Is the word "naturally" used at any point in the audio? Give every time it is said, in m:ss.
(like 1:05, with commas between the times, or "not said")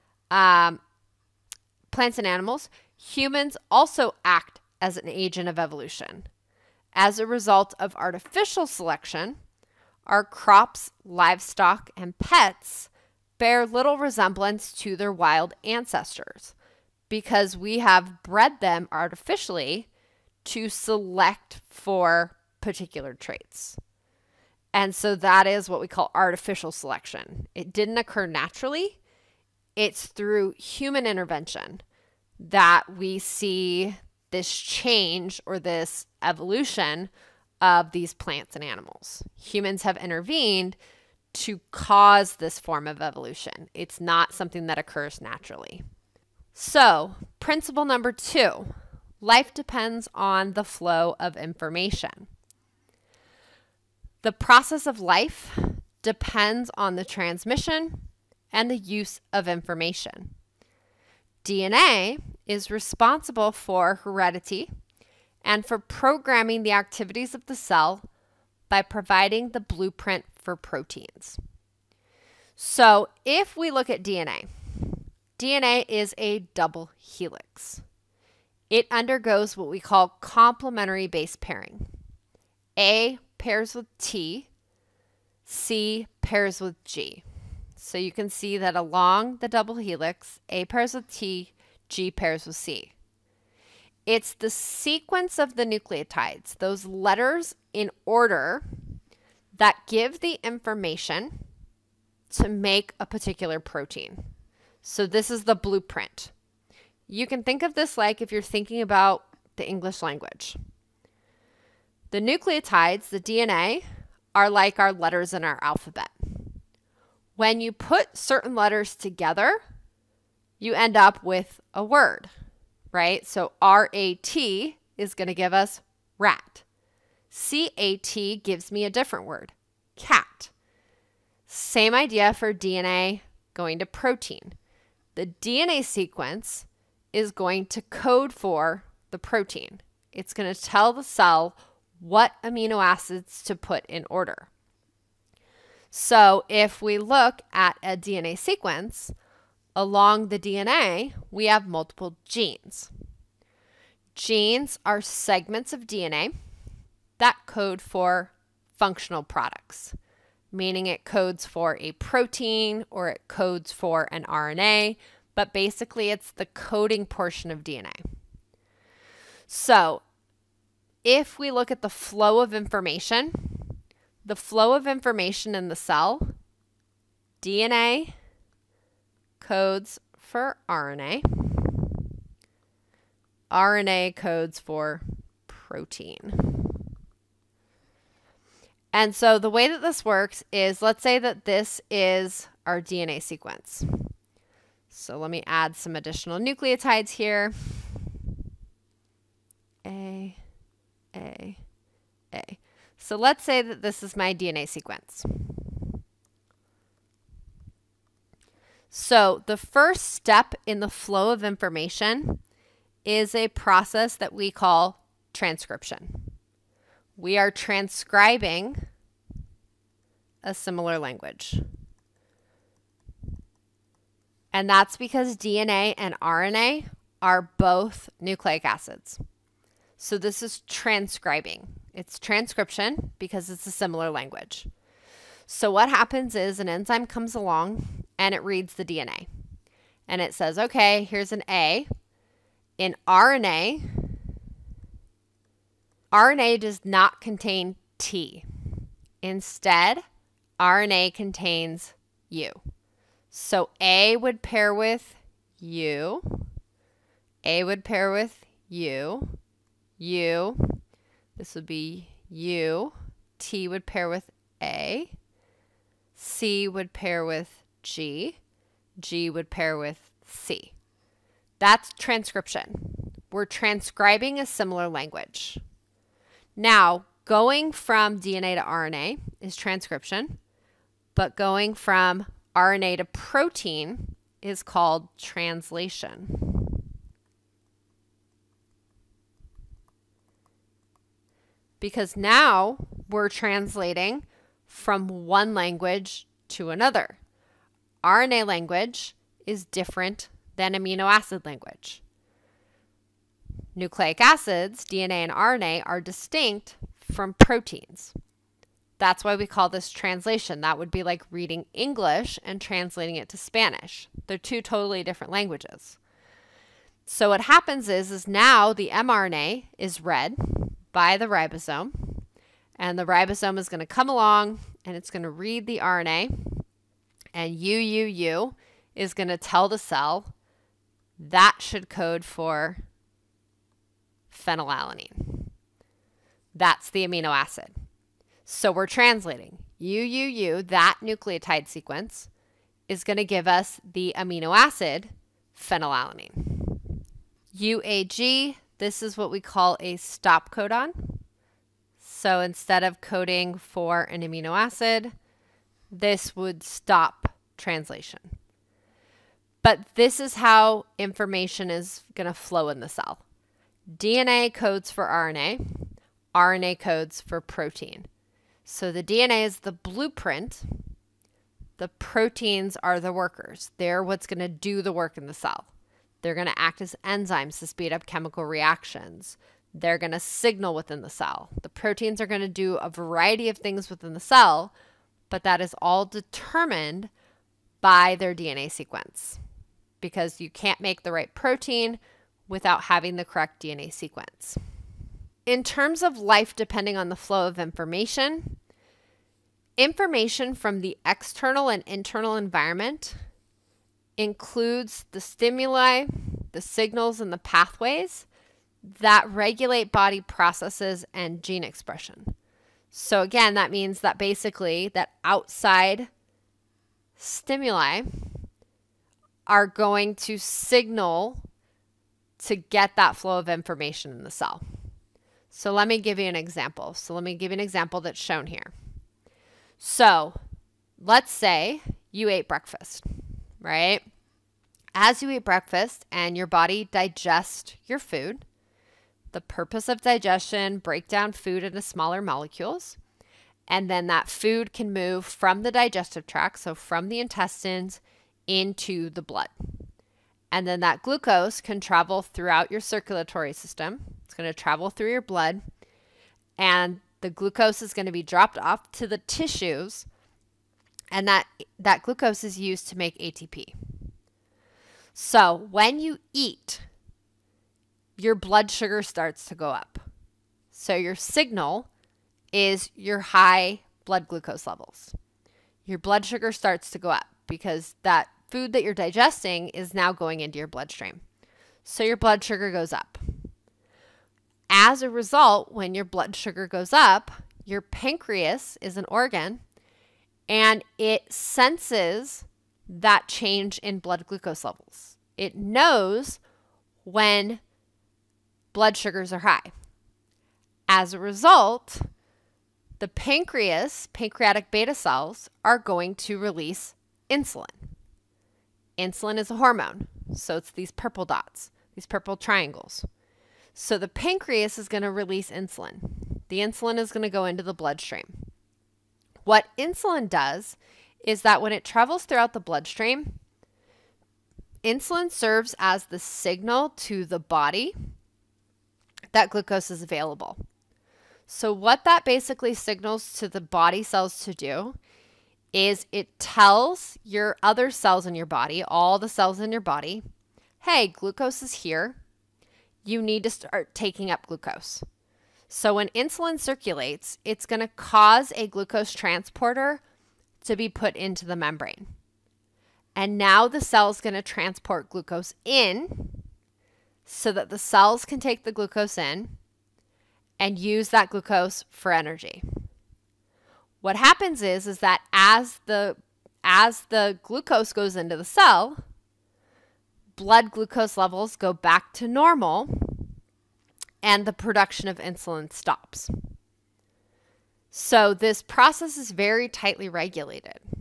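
0:28, 0:45.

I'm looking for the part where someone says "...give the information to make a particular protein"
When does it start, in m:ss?
1:39.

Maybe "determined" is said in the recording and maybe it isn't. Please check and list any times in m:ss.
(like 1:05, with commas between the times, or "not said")
6:26.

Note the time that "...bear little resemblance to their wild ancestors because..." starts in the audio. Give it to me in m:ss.
0:13.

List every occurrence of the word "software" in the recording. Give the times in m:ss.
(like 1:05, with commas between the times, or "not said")
not said.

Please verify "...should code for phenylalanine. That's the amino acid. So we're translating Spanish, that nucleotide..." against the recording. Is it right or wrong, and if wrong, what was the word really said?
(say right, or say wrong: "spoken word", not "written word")
wrong: "UUU", not "Spanish".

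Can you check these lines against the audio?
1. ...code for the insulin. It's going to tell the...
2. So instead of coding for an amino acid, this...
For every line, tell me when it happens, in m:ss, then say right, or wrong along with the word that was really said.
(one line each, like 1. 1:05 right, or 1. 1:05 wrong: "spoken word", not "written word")
1. 2:17 wrong: "protein", not "insulin"
2. 5:52 right.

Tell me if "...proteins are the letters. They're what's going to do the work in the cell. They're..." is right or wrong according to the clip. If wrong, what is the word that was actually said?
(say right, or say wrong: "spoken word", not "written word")
wrong: "workers", not "letters".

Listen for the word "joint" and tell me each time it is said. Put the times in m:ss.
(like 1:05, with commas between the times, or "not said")
not said.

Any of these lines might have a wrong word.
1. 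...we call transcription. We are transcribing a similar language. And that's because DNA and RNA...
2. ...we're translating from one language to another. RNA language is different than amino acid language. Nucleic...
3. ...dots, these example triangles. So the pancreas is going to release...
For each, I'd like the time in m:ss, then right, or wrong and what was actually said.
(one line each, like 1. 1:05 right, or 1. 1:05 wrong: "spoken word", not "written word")
1. 3:34 right
2. 4:53 right
3. 8:31 wrong: "purple", not "example".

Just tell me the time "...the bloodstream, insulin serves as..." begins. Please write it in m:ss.
8:42.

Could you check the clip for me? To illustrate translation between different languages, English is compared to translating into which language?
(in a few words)
Spanish.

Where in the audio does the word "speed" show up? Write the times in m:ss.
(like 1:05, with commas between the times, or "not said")
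6:17.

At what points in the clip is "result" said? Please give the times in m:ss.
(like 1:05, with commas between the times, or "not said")
0:07, 8:05, 8:21.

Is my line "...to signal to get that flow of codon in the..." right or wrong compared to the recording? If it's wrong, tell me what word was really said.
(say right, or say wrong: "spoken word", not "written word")
wrong: "information", not "codon".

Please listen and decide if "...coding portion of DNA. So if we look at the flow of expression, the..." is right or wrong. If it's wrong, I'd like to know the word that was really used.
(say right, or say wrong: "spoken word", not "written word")
wrong: "information", not "expression".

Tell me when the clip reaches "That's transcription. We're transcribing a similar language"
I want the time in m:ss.
4:31.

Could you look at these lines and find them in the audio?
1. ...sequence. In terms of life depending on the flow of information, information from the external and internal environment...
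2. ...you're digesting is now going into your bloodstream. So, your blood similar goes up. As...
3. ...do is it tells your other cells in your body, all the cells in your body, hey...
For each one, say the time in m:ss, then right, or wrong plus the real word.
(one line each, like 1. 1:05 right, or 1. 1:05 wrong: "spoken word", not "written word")
1. 6:33 right
2. 7:58 wrong: "sugar", not "similar"
3. 8:54 right.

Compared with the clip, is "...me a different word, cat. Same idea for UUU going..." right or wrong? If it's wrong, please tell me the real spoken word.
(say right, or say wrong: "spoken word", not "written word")
wrong: "DNA", not "UUU".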